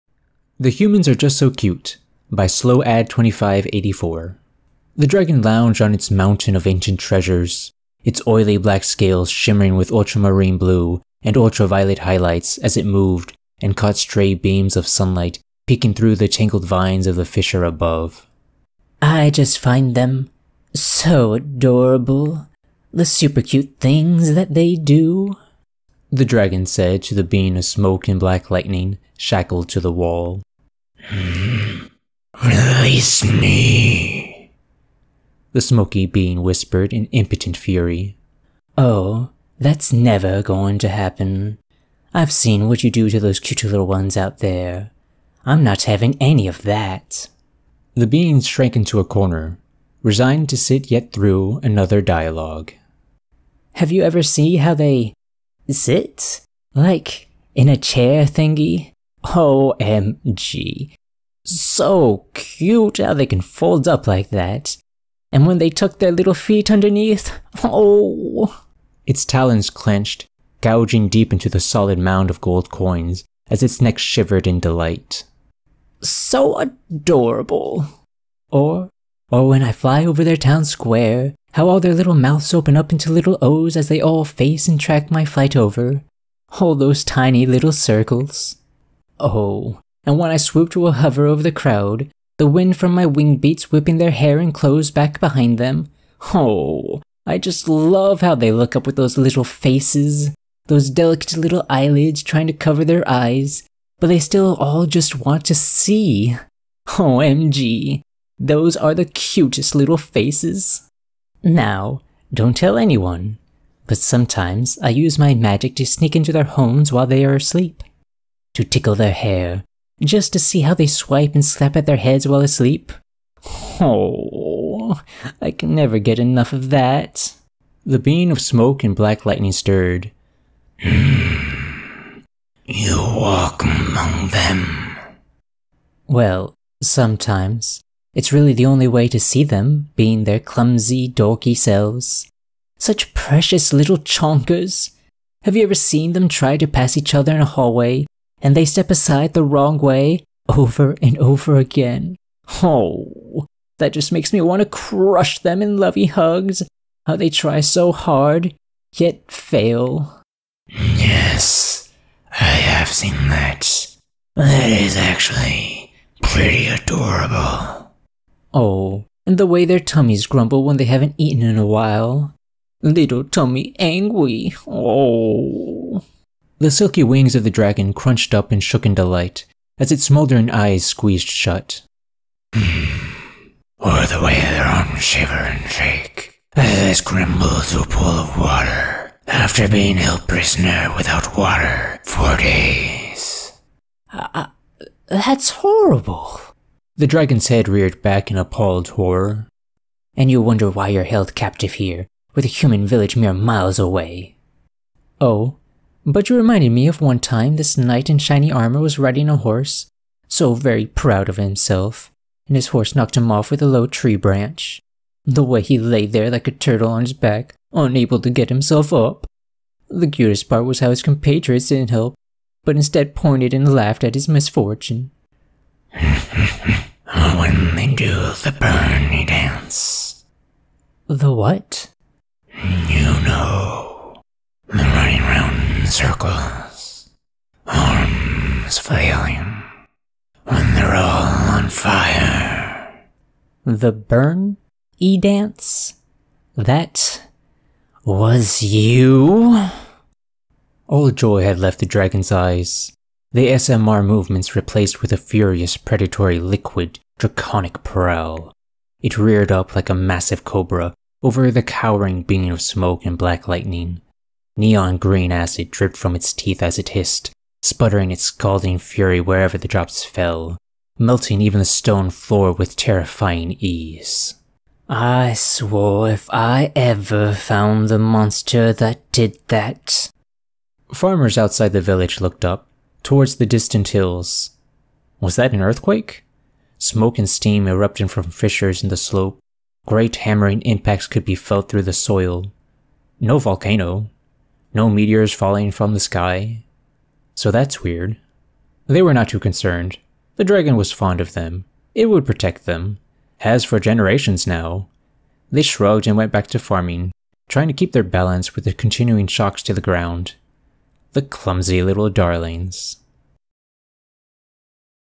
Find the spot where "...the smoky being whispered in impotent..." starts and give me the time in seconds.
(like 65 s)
35 s.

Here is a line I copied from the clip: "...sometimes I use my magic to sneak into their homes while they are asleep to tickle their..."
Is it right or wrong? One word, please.
right.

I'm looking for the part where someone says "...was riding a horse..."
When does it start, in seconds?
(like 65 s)
208 s.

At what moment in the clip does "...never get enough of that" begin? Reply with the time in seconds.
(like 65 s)
125 s.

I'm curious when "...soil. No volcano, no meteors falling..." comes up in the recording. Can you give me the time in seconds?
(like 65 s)
291 s.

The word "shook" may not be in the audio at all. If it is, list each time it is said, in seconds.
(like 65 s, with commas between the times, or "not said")
178 s.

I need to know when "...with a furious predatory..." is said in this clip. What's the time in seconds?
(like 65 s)
255 s.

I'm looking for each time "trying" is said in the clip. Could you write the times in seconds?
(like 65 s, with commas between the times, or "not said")
102 s, 307 s.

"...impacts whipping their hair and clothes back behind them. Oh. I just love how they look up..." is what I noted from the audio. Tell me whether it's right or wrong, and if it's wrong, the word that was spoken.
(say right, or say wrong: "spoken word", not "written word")
wrong: "beats", not "impacts".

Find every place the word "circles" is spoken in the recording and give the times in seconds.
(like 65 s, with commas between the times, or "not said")
87 s, 235 s.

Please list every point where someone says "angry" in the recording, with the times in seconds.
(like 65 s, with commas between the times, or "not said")
173 s.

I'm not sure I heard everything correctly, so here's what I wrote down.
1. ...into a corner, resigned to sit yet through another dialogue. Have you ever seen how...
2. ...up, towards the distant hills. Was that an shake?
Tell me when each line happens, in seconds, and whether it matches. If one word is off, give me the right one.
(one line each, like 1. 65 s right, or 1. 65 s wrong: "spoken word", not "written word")
1. 48 s right
2. 282 s wrong: "earthquake", not "shake".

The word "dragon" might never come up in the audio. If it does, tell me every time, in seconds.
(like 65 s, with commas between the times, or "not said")
5 s, 26 s, 177 s, 197 s, 251 s, 300 s.